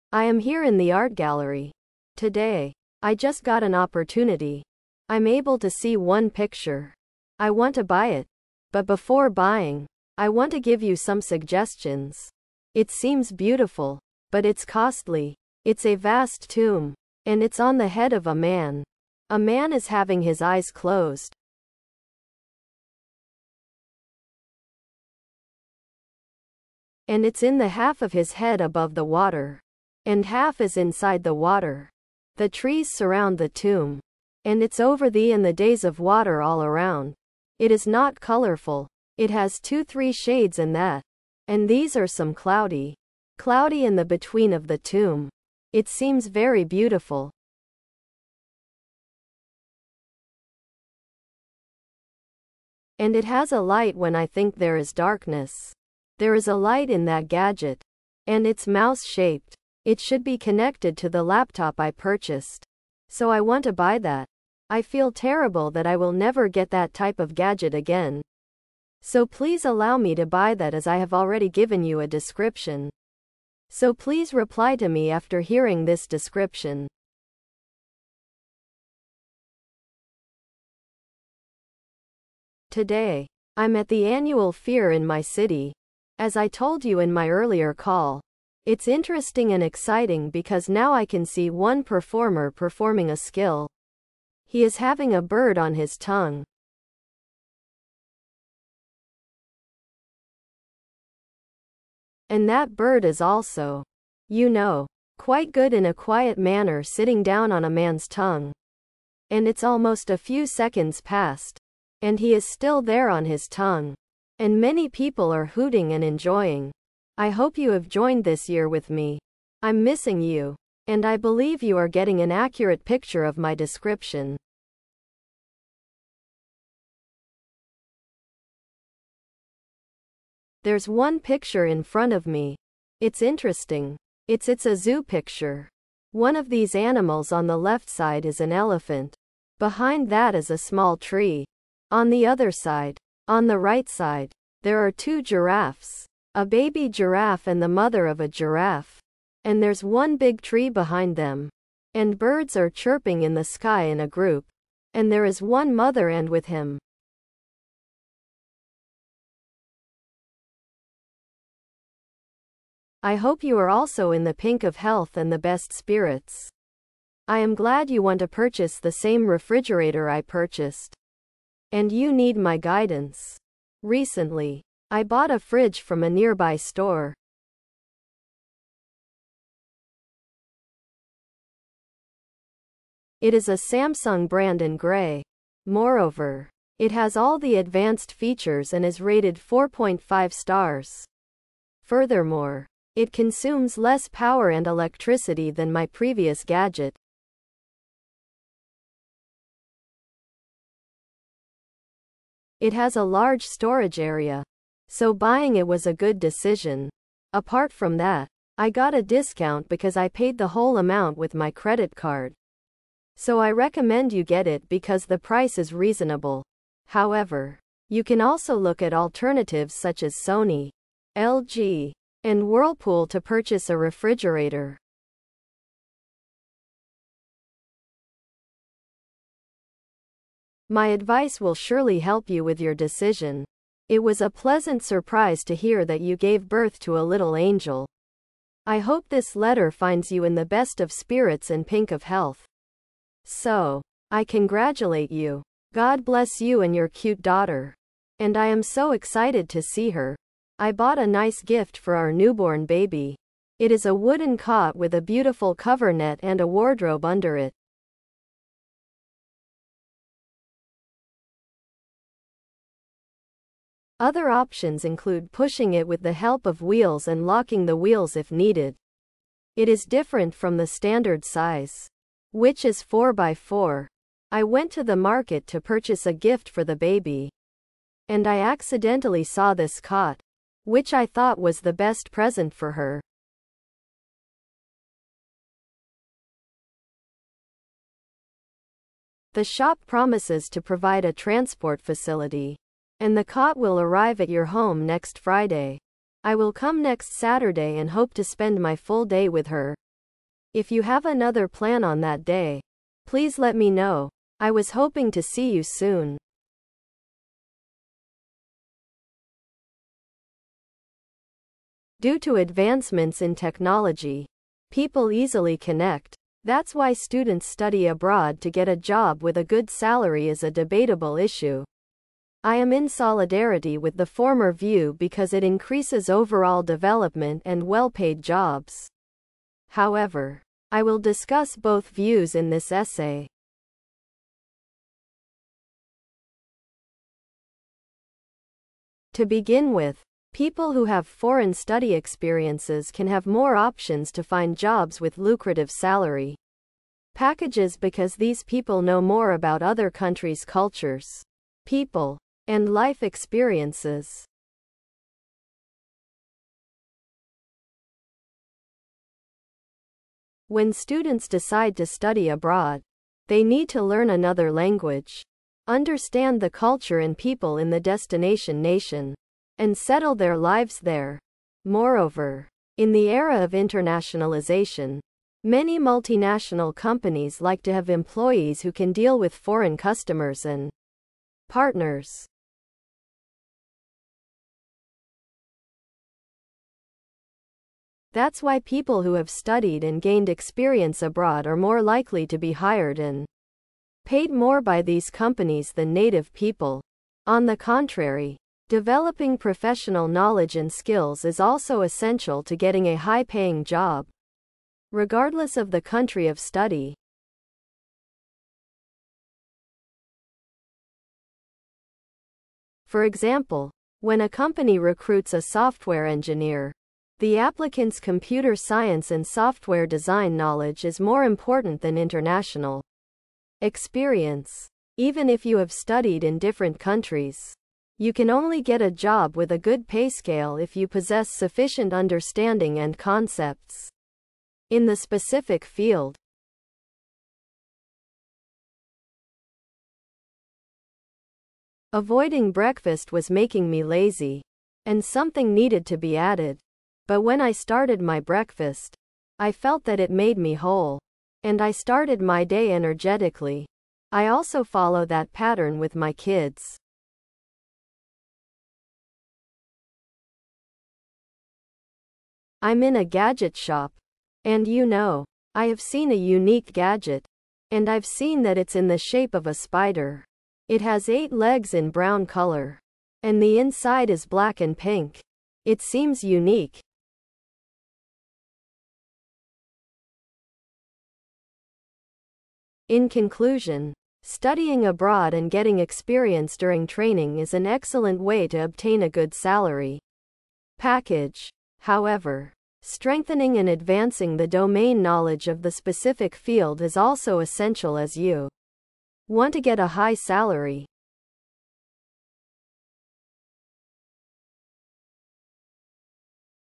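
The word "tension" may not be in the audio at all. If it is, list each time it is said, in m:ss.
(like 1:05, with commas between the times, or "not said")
not said.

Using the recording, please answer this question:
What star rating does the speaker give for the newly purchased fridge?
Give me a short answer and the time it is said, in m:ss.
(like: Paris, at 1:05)
4.5 stars, at 3:09.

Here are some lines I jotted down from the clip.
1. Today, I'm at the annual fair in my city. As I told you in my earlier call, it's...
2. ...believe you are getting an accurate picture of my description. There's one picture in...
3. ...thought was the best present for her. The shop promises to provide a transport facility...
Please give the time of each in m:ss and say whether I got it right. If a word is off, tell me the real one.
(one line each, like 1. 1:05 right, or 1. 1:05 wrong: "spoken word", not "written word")
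1. 1:22 right
2. 2:01 right
3. 4:41 right.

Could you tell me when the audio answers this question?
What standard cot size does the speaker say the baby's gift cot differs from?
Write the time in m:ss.
4:32.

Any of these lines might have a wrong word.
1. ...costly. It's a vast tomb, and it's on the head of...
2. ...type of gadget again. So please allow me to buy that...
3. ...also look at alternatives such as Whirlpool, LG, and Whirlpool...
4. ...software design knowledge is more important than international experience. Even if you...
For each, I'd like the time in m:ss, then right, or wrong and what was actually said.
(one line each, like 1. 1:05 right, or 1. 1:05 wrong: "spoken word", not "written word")
1. 0:14 right
2. 1:06 right
3. 3:38 wrong: "Sony", not "Whirlpool"
4. 6:59 right.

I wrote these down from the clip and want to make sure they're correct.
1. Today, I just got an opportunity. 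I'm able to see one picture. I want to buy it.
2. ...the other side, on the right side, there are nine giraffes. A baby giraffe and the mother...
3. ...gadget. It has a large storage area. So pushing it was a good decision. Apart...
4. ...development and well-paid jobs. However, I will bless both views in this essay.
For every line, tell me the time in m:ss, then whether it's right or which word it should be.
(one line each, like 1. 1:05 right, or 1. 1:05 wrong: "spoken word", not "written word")
1. 0:02 right
2. 2:22 wrong: "two", not "nine"
3. 3:16 wrong: "buying", not "pushing"
4. 5:26 wrong: "discuss", not "bless".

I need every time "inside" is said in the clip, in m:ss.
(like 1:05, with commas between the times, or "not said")
0:30, 7:53.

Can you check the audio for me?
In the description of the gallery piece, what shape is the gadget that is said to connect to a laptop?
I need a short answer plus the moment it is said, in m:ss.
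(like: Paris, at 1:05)
Mouse-shaped, at 0:58.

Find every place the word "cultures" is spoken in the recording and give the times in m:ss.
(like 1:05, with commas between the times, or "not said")
5:50, 6:06.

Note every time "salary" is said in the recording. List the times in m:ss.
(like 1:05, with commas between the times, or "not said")
5:19, 5:45, 8:09, 8:20.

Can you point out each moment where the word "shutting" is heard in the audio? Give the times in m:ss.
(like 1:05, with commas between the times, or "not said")
not said.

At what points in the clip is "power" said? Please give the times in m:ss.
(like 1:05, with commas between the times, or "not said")
3:14.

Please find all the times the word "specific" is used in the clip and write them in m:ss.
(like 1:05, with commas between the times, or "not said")
7:14, 8:15.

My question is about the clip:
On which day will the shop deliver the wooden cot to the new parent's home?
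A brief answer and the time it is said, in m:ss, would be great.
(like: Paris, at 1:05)
Next Friday, at 4:54.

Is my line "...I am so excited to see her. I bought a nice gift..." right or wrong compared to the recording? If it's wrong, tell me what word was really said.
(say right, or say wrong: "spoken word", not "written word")
right.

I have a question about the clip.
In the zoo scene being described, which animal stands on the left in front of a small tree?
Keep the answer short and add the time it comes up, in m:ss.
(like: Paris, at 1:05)
Elephant, at 2:18.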